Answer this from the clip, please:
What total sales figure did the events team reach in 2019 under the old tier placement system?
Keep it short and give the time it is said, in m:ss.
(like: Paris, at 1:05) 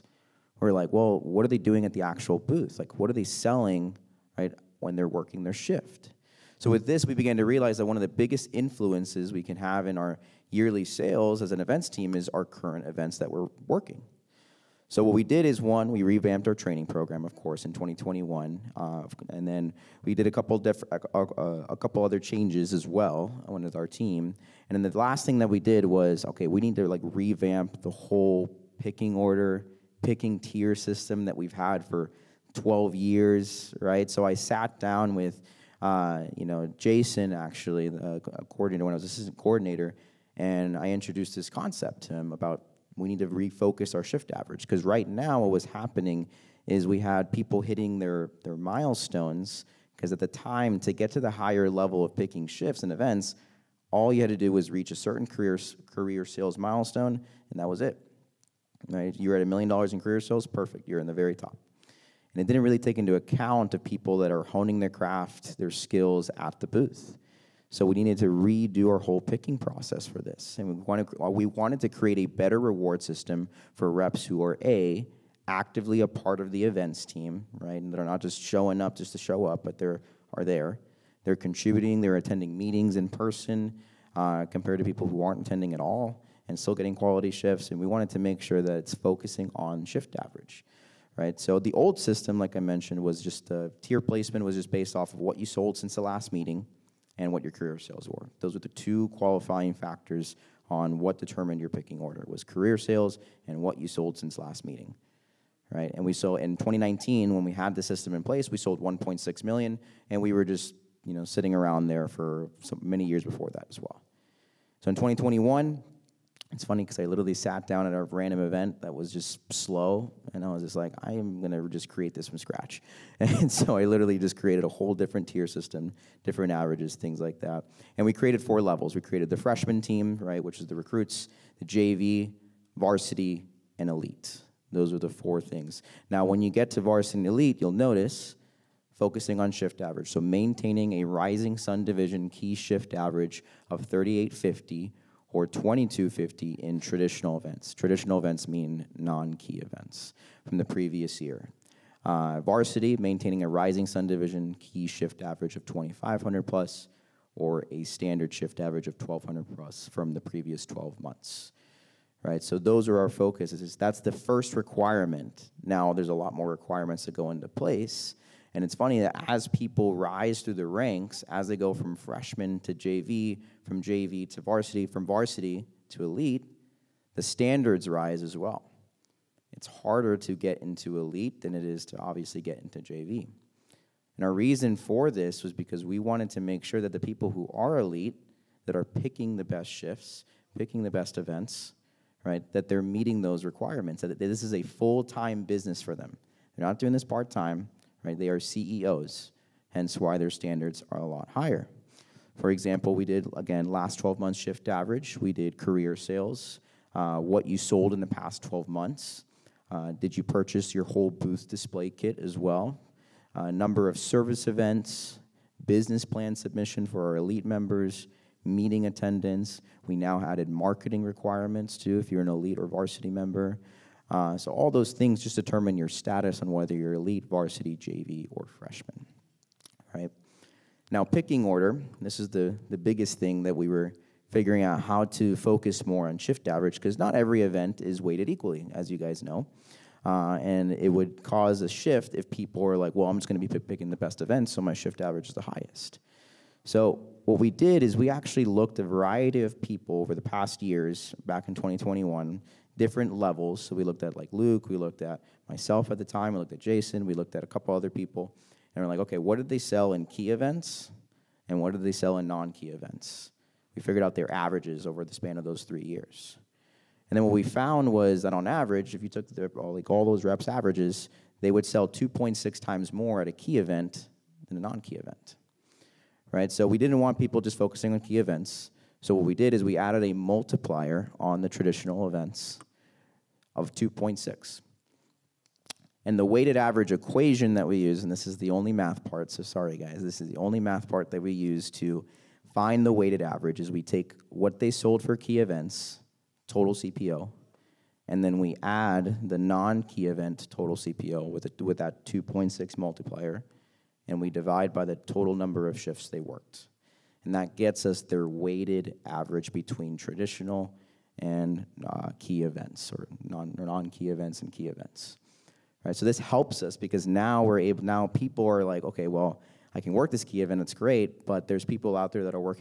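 1.6 million, at 1:48.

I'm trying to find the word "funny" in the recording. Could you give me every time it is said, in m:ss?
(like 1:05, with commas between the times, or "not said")
1:56, 2:48.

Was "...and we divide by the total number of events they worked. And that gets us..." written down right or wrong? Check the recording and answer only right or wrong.
wrong.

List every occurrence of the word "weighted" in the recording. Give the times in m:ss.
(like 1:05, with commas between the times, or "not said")
3:58, 4:46, 4:52, 5:08.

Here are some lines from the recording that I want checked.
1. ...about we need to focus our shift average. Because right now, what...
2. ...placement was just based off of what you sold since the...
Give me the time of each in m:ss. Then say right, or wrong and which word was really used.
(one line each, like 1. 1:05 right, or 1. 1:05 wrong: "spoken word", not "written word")
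1. 0:42 wrong: "refocus", not "focus"
2. 1:34 right.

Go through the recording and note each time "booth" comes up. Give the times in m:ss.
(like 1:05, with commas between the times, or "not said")
0:02, 1:06, 3:31.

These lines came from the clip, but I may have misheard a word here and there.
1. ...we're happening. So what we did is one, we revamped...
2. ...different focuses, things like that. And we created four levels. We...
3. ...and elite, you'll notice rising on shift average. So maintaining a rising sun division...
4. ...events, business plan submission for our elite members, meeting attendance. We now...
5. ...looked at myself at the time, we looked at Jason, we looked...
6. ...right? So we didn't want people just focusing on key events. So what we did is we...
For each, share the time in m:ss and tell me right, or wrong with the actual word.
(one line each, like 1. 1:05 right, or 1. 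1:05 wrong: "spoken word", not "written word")
1. 0:13 wrong: "working", not "happening"
2. 2:06 wrong: "averages", not "focuses"
3. 2:17 wrong: "focusing", not "rising"
4. 3:34 right
5. 4:14 right
6. 4:36 right.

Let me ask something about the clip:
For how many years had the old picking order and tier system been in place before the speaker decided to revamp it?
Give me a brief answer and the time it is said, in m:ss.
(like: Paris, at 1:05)
12 years, at 0:32.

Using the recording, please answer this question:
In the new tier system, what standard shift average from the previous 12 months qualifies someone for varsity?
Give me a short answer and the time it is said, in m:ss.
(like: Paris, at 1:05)
1200, at 2:38.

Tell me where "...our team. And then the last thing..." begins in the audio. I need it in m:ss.
0:23.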